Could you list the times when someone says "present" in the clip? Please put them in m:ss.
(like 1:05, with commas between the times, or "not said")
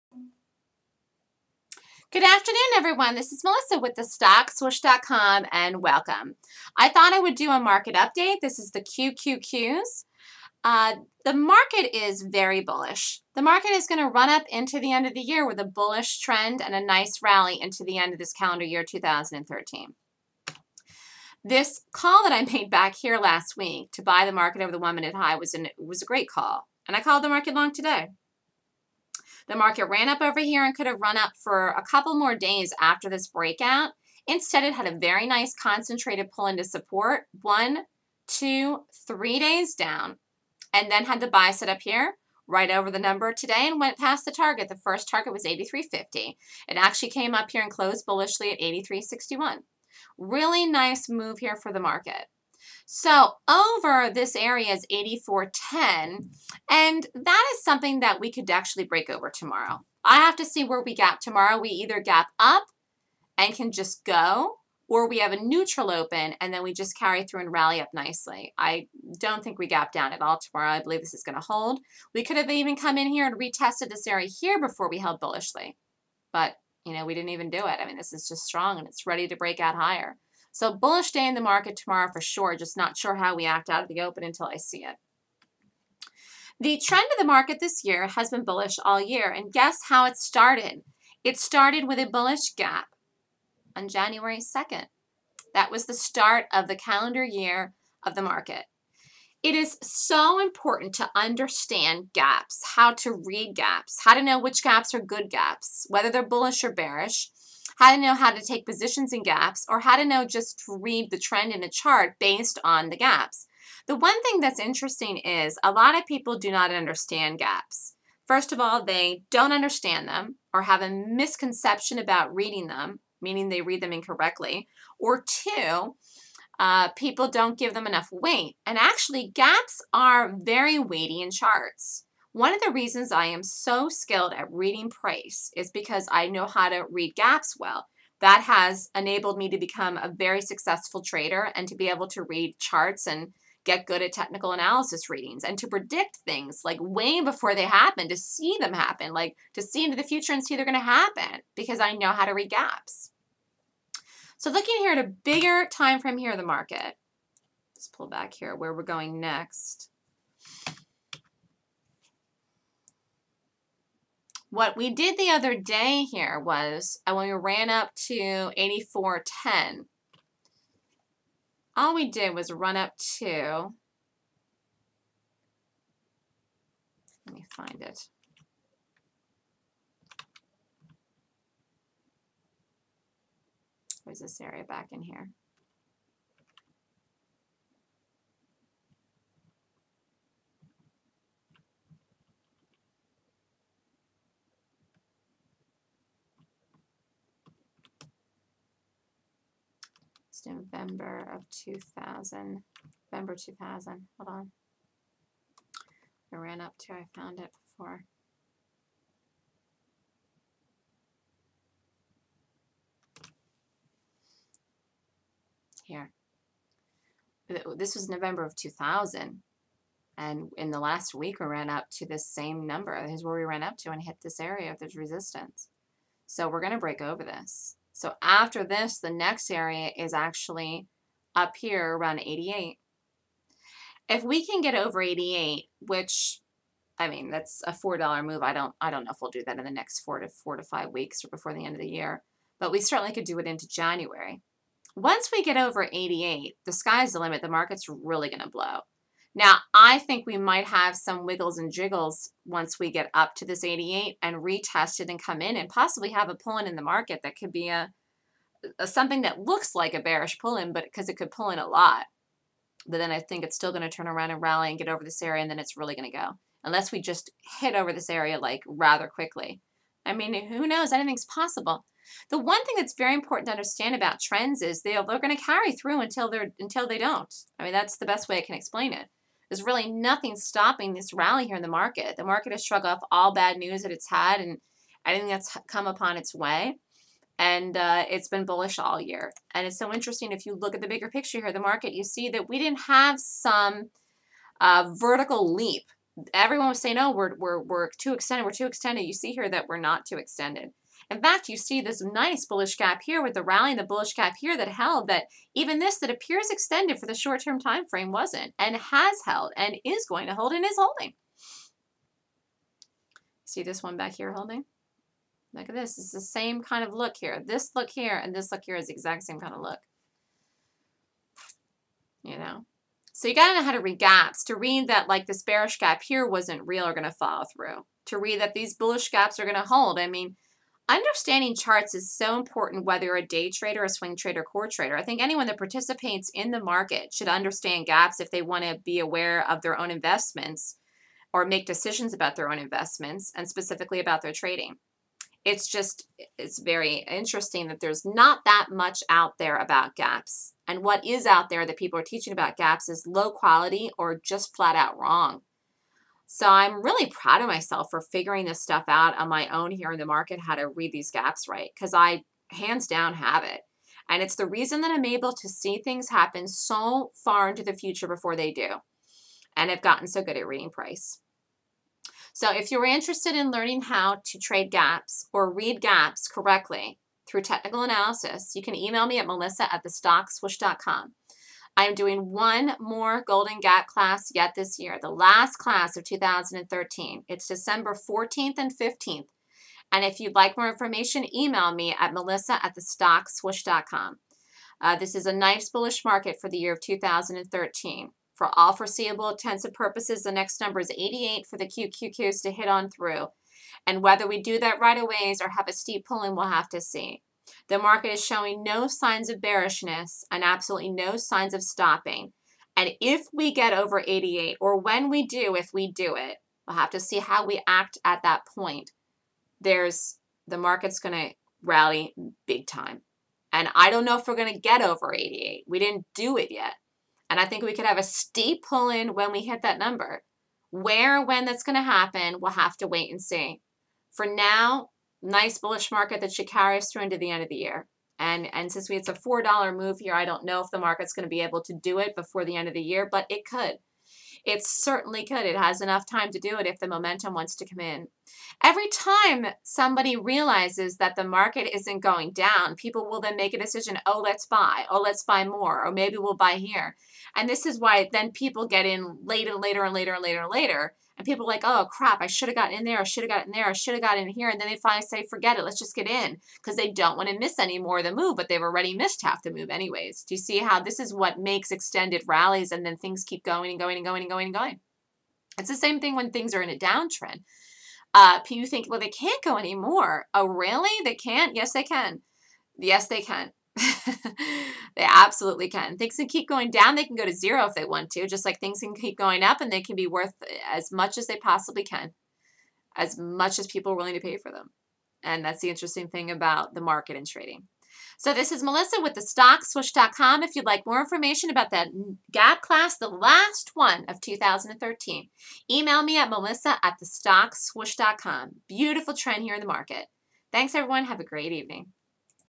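not said.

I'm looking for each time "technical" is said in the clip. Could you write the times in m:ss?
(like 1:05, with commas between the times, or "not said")
2:24, 6:17.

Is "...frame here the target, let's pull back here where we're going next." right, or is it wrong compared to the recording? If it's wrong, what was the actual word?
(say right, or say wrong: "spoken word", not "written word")
wrong: "market", not "target".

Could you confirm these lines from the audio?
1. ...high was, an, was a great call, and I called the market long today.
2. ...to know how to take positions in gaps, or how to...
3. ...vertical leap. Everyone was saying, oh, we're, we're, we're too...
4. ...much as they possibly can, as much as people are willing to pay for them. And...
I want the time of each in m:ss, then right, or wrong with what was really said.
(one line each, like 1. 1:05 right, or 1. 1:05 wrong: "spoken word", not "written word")
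1. 0:25 right
2. 1:47 right
3. 4:54 right
4. 8:10 right.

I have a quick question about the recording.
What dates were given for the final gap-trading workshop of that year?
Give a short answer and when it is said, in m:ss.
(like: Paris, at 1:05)
December 14th and 15th, at 6:27.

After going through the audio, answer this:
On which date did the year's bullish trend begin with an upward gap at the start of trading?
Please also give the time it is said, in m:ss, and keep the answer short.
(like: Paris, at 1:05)
January 2nd, at 1:33.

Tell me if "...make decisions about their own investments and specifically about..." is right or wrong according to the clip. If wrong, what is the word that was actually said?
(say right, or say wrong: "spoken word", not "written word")
right.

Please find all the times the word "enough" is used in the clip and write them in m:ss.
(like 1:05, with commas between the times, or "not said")
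2:07, 7:25.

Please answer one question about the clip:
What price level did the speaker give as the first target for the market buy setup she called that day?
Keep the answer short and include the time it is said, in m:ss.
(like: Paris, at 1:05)
83.50, at 0:45.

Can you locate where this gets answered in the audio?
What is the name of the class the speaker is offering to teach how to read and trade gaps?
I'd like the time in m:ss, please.
6:23.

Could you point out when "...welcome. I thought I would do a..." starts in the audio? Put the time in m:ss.
0:05.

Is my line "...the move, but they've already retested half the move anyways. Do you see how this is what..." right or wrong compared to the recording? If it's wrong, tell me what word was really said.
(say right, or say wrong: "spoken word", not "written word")
wrong: "missed", not "retested".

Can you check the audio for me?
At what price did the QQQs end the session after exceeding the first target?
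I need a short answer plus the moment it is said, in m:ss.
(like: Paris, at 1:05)
83.61, at 0:48.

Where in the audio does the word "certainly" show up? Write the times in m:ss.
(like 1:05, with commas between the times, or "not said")
4:02, 7:24.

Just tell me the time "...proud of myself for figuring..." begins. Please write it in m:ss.
5:57.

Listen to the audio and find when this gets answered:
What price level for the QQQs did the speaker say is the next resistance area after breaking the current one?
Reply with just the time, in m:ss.
3:51.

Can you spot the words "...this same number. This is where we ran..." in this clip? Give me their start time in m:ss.
3:42.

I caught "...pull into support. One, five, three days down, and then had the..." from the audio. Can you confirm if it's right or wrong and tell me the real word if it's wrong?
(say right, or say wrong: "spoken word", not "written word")
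wrong: "two", not "five".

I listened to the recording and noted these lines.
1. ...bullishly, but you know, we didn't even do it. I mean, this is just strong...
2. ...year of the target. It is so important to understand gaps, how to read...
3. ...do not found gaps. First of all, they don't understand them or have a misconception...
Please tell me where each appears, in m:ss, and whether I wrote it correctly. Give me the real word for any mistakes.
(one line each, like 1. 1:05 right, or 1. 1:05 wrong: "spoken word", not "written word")
1. 1:15 right
2. 1:37 wrong: "market", not "target"
3. 1:56 wrong: "understand", not "found".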